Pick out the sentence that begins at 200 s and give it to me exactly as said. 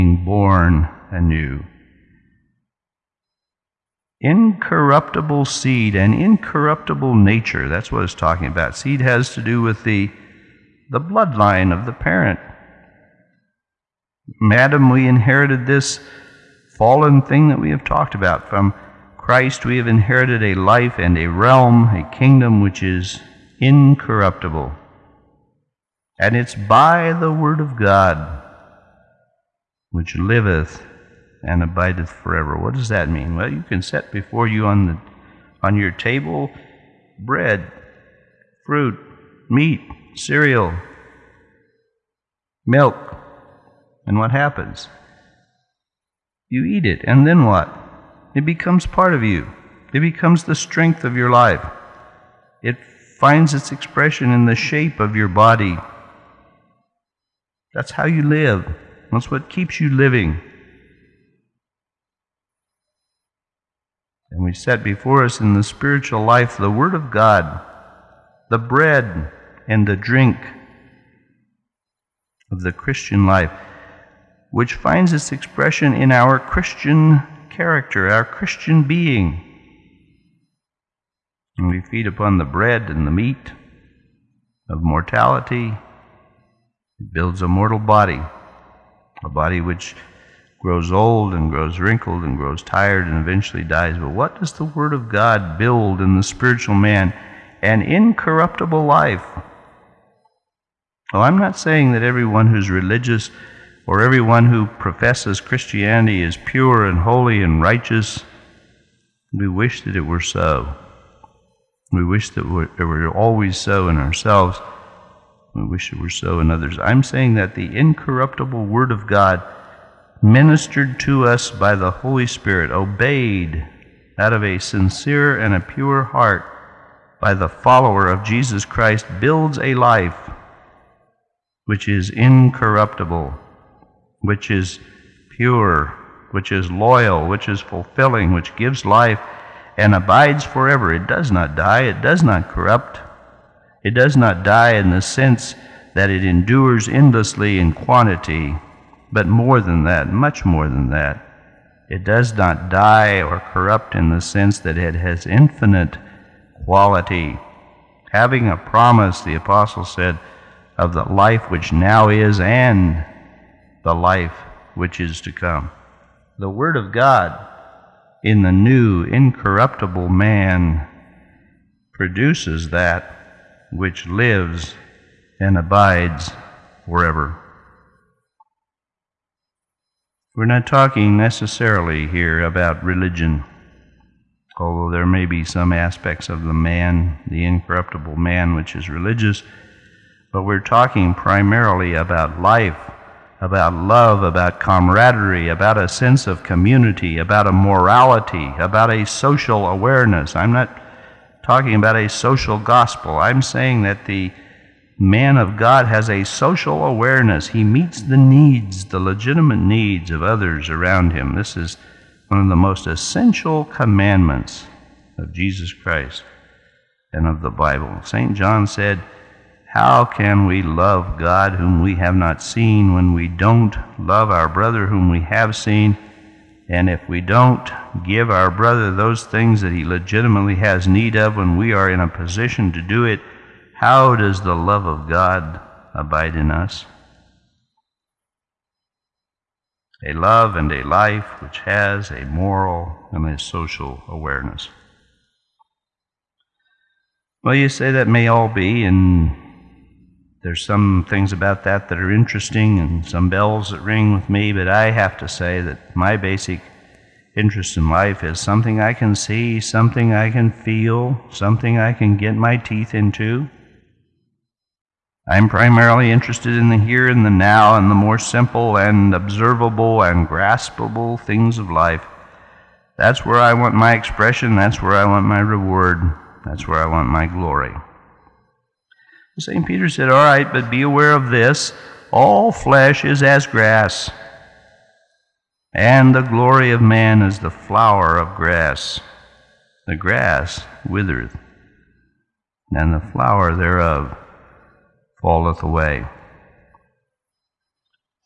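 I'm not talking about a social gospel.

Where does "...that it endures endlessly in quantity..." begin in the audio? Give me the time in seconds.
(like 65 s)
145 s.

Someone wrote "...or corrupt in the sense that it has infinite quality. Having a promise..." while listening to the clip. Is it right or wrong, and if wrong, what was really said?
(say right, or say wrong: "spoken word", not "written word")
right.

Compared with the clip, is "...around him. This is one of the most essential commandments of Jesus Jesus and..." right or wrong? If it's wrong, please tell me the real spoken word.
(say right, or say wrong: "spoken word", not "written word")
wrong: "Christ", not "Jesus".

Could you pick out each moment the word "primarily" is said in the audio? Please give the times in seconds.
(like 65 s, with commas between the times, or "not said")
191 s, 265 s.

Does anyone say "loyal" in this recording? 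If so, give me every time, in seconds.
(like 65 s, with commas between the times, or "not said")
136 s.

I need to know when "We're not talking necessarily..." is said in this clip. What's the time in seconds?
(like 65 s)
180 s.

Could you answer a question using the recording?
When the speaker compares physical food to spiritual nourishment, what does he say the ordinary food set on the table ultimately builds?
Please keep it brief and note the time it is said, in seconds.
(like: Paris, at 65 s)
a mortal body, at 87 s.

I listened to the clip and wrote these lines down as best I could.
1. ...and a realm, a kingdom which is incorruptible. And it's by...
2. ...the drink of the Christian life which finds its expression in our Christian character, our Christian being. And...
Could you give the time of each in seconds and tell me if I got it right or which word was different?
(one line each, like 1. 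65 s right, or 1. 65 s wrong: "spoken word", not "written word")
1. 20 s right
2. 69 s right.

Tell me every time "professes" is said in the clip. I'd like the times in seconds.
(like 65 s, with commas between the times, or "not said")
104 s.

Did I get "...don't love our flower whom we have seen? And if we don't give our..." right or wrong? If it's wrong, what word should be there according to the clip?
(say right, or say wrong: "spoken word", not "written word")
wrong: "brother", not "flower".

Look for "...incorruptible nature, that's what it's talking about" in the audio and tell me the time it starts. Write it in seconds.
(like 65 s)
6 s.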